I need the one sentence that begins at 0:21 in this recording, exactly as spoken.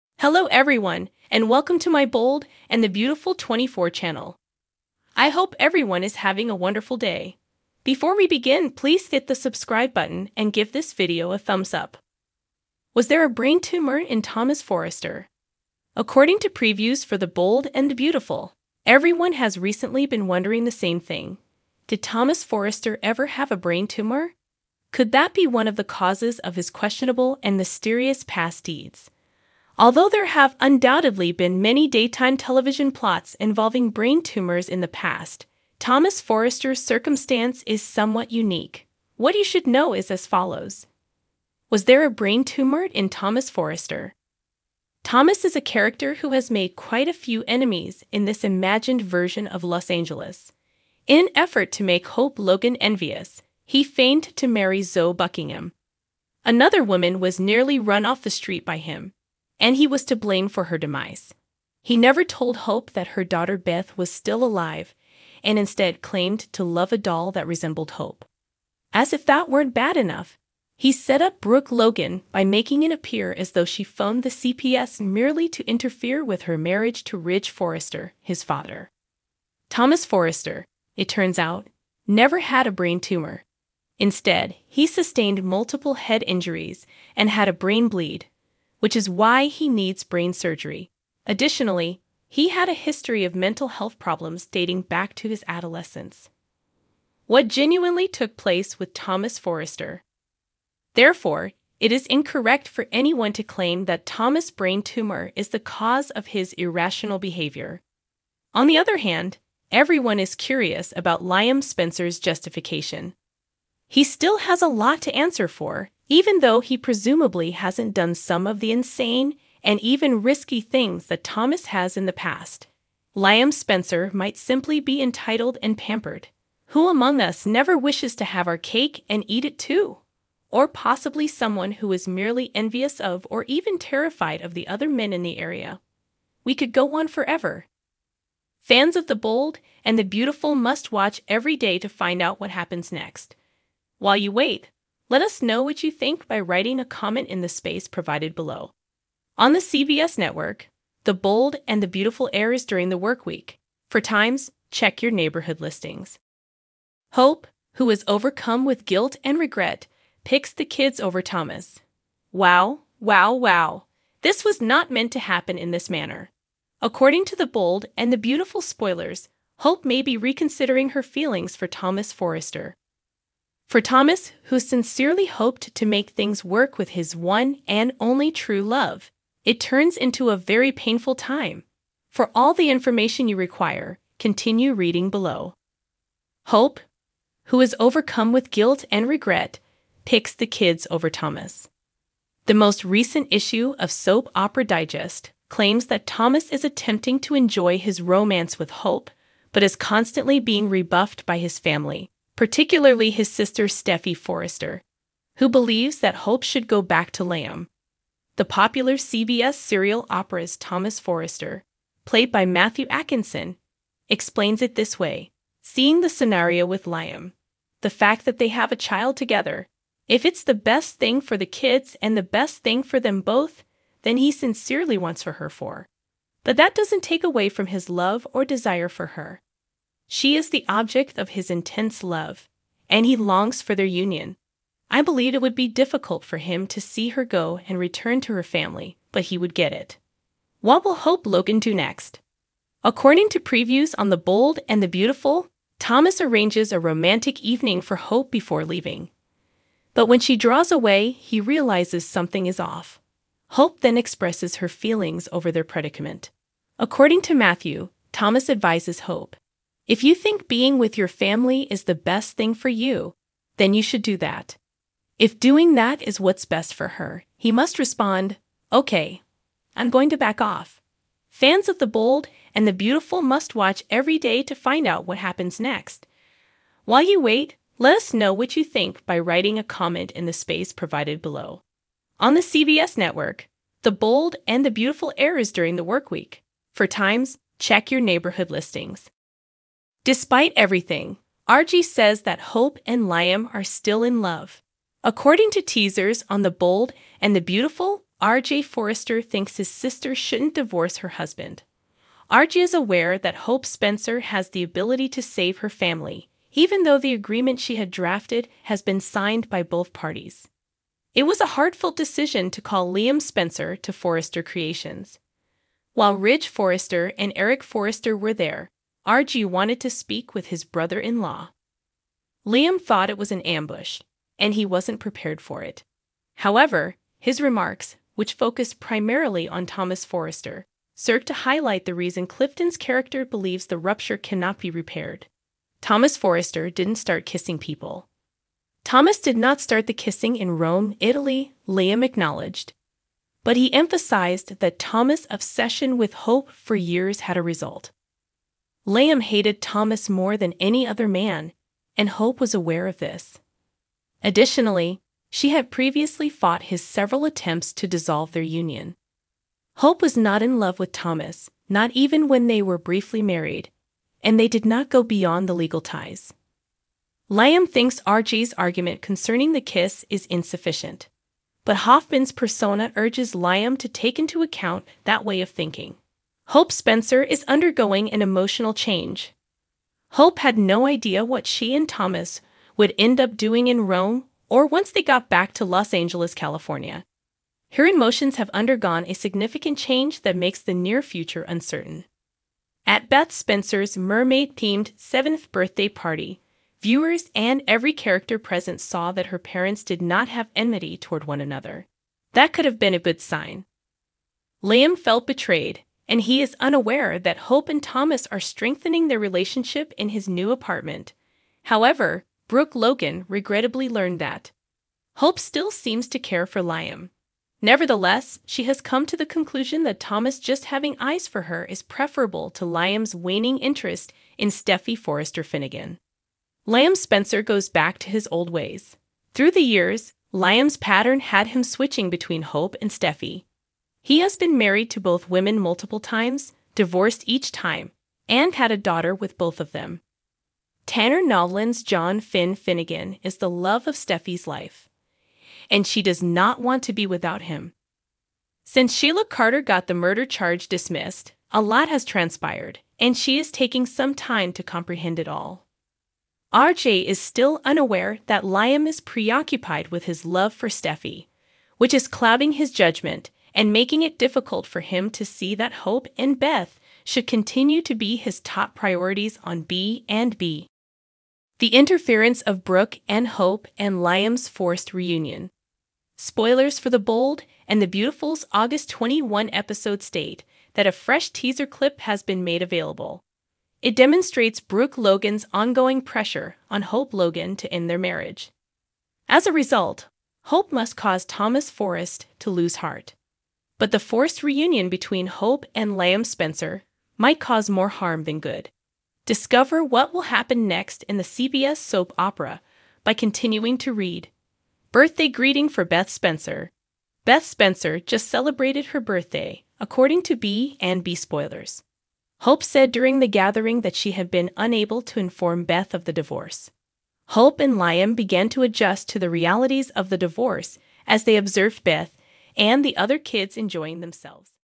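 Did Thomas Forrester ever have a brain tumor?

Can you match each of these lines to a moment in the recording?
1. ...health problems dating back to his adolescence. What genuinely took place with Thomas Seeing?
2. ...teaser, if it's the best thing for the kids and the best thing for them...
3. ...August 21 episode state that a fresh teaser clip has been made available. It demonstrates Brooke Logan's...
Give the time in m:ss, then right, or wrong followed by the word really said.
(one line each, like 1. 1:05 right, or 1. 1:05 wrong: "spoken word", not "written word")
1. 1:33 wrong: "Forrester", not "Seeing"
2. 3:39 wrong: "together", not "teaser"
3. 7:58 right.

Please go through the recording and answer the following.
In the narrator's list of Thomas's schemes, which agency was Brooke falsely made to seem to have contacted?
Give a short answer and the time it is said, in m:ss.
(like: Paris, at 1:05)
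CPS, at 1:14.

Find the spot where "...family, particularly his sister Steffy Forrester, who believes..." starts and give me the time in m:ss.
3:21.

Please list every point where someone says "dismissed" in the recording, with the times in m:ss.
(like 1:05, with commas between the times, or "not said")
7:30.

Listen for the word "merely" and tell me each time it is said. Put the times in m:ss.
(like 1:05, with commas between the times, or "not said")
1:14, 2:12.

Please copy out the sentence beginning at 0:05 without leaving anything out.
I hope everyone is having a wonderful day.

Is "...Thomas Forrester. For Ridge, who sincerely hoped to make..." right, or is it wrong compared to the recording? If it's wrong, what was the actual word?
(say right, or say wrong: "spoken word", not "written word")
wrong: "Thomas", not "Ridge".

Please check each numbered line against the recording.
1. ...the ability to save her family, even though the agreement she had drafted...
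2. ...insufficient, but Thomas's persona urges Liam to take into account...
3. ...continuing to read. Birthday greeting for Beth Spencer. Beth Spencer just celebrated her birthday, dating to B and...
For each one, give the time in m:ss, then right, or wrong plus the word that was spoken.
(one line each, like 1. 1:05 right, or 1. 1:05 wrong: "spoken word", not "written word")
1. 5:04 right
2. 6:10 wrong: "Hoffman", not "Thomas"
3. 8:23 wrong: "according", not "dating".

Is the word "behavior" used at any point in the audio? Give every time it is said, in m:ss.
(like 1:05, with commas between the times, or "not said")
1:47.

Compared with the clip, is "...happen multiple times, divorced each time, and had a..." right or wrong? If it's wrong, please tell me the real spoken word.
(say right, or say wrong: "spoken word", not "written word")
wrong: "women", not "happen".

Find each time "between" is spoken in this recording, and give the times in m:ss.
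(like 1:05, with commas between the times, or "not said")
7:12, 8:14.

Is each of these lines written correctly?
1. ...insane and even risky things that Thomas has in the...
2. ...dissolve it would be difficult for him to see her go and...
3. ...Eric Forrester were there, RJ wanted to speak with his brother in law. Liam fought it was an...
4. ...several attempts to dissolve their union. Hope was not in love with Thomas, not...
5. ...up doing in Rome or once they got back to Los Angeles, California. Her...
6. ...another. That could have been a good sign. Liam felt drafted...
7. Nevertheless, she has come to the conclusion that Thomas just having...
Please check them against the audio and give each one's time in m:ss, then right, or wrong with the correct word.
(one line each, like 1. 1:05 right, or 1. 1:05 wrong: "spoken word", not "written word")
1. 1:58 right
2. 3:55 wrong: "believe", not "dissolve"
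3. 5:17 wrong: "thought", not "fought"
4. 5:56 right
5. 6:23 right
6. 6:41 wrong: "betrayed", not "drafted"
7. 6:57 right.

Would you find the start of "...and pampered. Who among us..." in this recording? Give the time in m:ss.
2:05.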